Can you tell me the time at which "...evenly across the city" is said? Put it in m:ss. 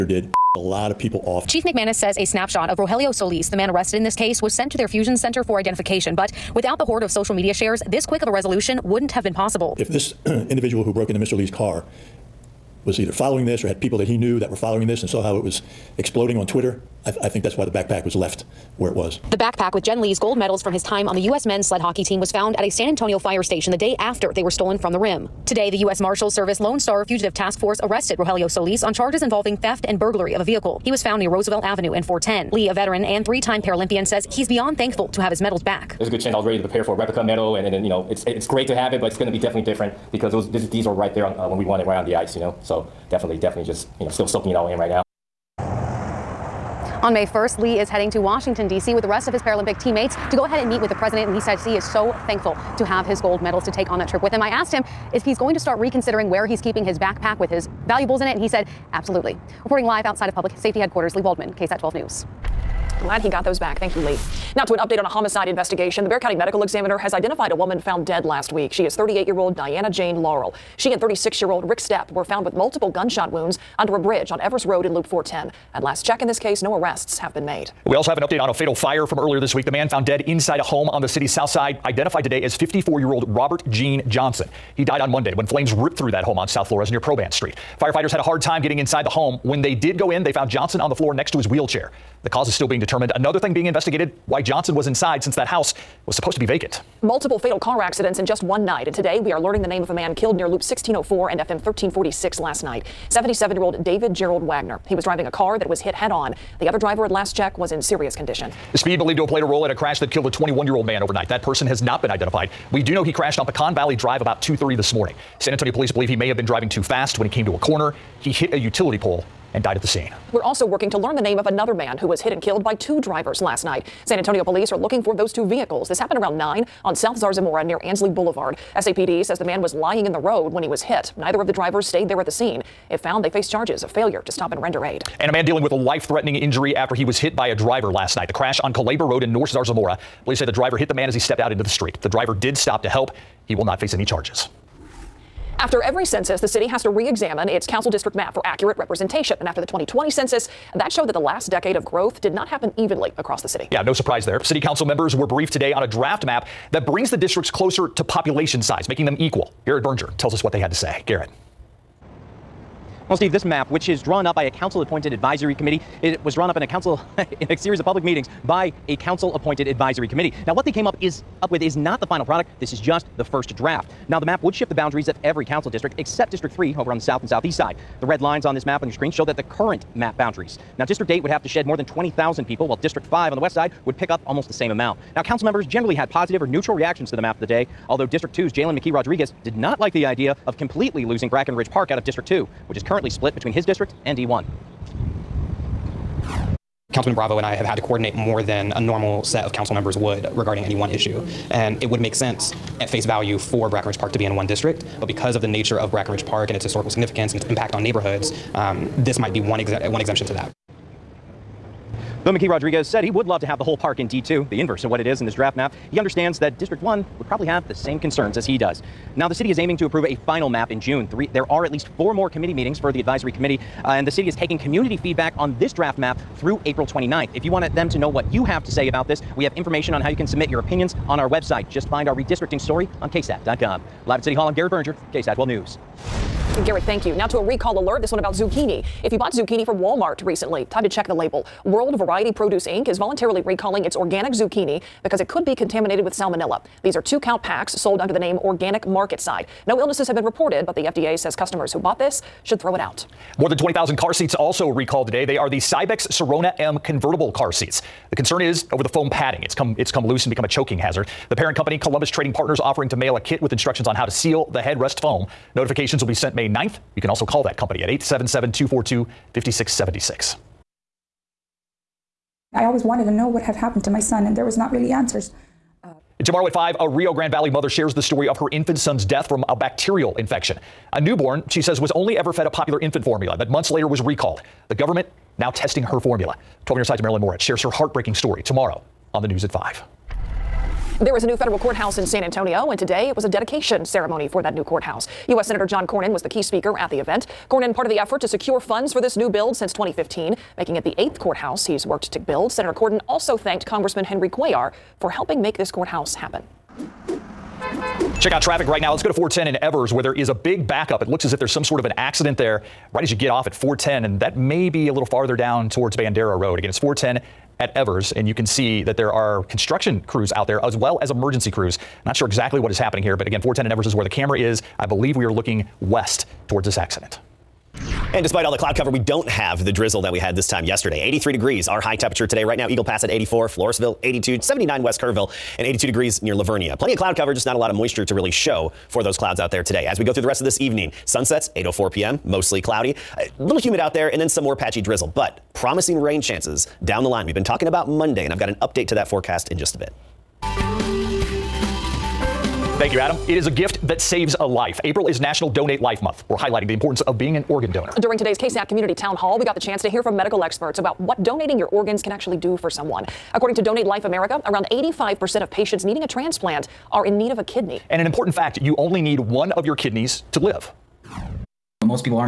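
2:32.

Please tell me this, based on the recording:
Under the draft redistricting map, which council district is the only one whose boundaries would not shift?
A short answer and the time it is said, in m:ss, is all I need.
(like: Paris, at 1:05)
District 3, at 2:56.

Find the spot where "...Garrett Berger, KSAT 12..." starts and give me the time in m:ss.
3:54.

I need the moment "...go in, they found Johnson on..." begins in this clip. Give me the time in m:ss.
1:29.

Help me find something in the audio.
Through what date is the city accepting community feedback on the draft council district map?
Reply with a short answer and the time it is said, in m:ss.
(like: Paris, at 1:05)
April 29th, at 3:46.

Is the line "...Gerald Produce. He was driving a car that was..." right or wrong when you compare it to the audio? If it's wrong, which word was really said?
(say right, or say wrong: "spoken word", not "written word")
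wrong: "Wagner", not "Produce".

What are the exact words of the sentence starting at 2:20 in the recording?
Police say the driver hit the man as he stepped out into the street.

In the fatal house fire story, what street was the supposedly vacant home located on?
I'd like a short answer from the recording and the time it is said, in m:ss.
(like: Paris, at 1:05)
South Flores, at 1:26.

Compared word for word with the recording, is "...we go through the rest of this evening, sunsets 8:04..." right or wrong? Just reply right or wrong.
right.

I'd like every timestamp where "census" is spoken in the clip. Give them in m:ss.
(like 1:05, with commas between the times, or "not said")
2:26, 2:30.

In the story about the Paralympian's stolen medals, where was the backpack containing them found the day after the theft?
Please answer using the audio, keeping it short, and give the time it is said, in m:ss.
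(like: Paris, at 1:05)
San Antonio fire station, at 0:22.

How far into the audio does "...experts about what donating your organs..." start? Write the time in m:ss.
6:00.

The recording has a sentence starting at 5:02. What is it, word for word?
Senator Cornyn also thanked Congressman Henry Cuellar for helping make this courthouse happen.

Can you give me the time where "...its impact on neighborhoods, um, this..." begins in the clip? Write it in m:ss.
3:27.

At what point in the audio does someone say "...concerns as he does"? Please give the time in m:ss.
3:37.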